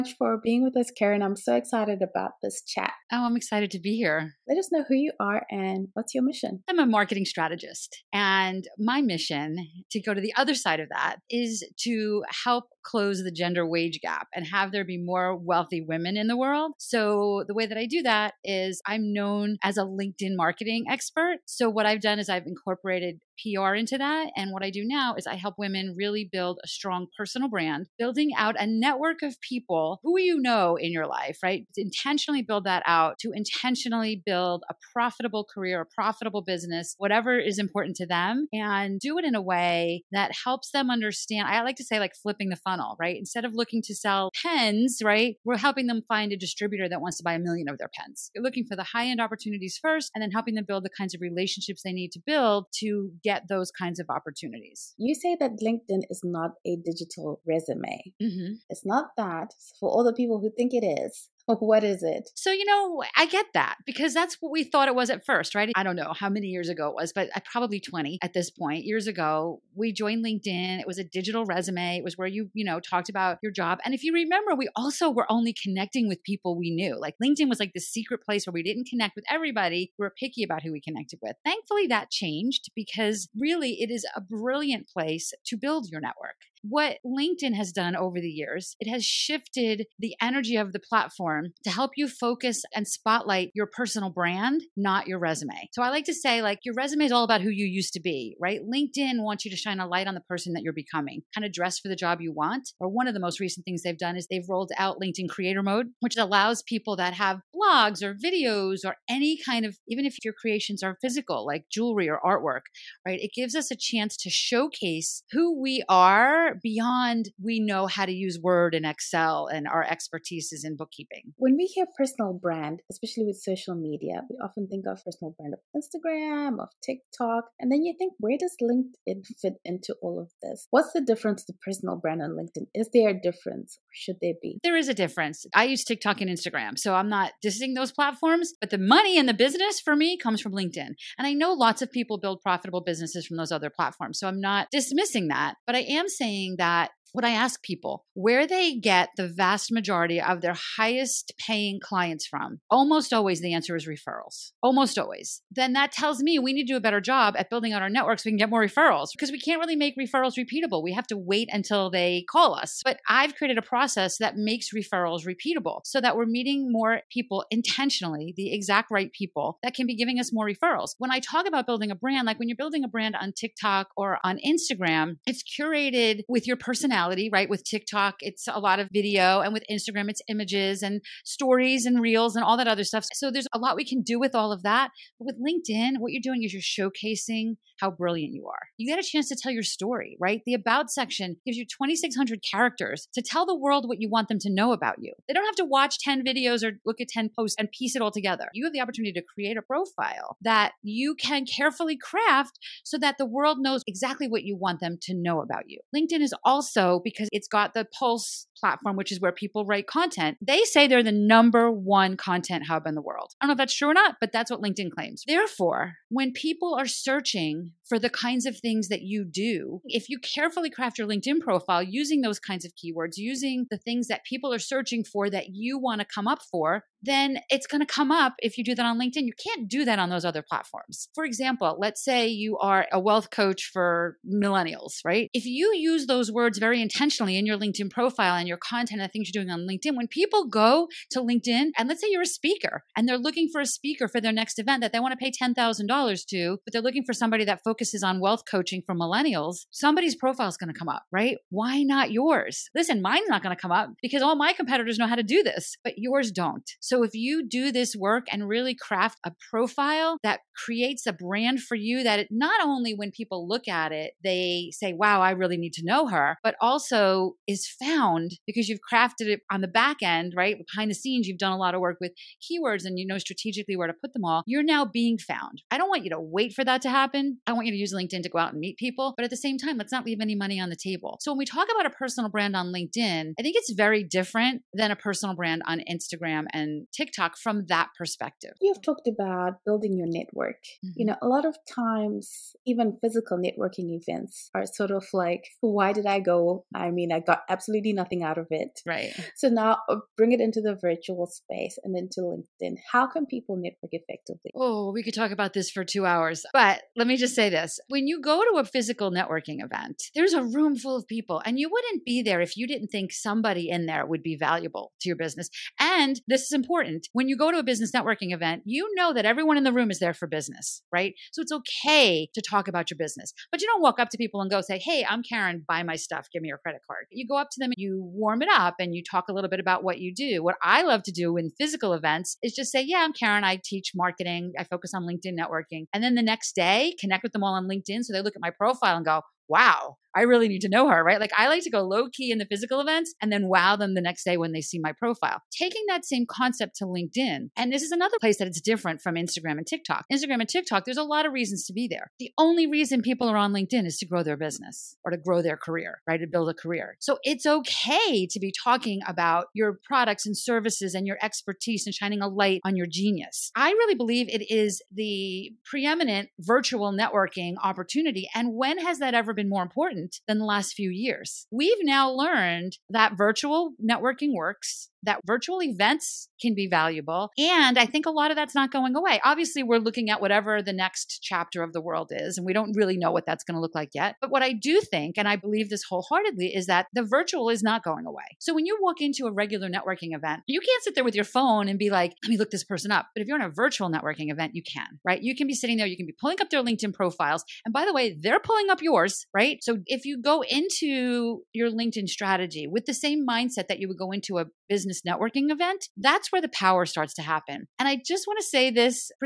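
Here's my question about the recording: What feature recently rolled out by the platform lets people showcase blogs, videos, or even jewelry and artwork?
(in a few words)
Creator Mode.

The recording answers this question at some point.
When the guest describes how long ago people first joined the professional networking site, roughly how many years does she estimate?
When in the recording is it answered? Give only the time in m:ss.
1:07.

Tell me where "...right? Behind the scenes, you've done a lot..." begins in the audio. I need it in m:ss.
4:30.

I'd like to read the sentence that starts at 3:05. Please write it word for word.
But with LinkedIn, what you're doing is you're showcasing how brilliant you are.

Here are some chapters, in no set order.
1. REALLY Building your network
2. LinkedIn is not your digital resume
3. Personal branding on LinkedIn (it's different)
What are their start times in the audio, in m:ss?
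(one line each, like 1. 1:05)
1. 4:52
2. 0:58
3. 2:05.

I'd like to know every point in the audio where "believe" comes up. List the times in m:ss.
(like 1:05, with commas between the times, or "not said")
6:03, 6:25.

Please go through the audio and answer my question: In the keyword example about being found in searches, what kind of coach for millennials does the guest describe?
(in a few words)
Wealth coach.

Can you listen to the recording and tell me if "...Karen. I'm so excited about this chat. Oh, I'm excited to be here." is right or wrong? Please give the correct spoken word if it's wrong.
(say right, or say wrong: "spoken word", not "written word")
right.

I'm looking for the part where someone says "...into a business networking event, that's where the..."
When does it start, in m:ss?
6:44.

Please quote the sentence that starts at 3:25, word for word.
LinkedIn is also because it's got the Pulse platform, which is where people write content.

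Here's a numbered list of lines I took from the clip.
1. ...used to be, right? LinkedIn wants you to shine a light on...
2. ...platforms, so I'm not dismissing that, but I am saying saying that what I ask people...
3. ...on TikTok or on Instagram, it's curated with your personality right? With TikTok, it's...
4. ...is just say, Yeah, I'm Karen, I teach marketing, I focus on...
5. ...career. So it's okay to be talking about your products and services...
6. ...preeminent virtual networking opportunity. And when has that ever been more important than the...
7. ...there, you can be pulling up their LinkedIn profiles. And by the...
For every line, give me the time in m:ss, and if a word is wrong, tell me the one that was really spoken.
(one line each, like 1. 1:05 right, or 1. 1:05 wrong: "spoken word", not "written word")
1. 1:37 right
2. 2:23 right
3. 2:53 right
4. 5:32 right
5. 5:56 right
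6. 6:05 right
7. 6:35 right.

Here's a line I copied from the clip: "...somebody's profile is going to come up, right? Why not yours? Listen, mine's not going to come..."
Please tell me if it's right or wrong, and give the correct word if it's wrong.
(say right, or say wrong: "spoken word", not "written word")
right.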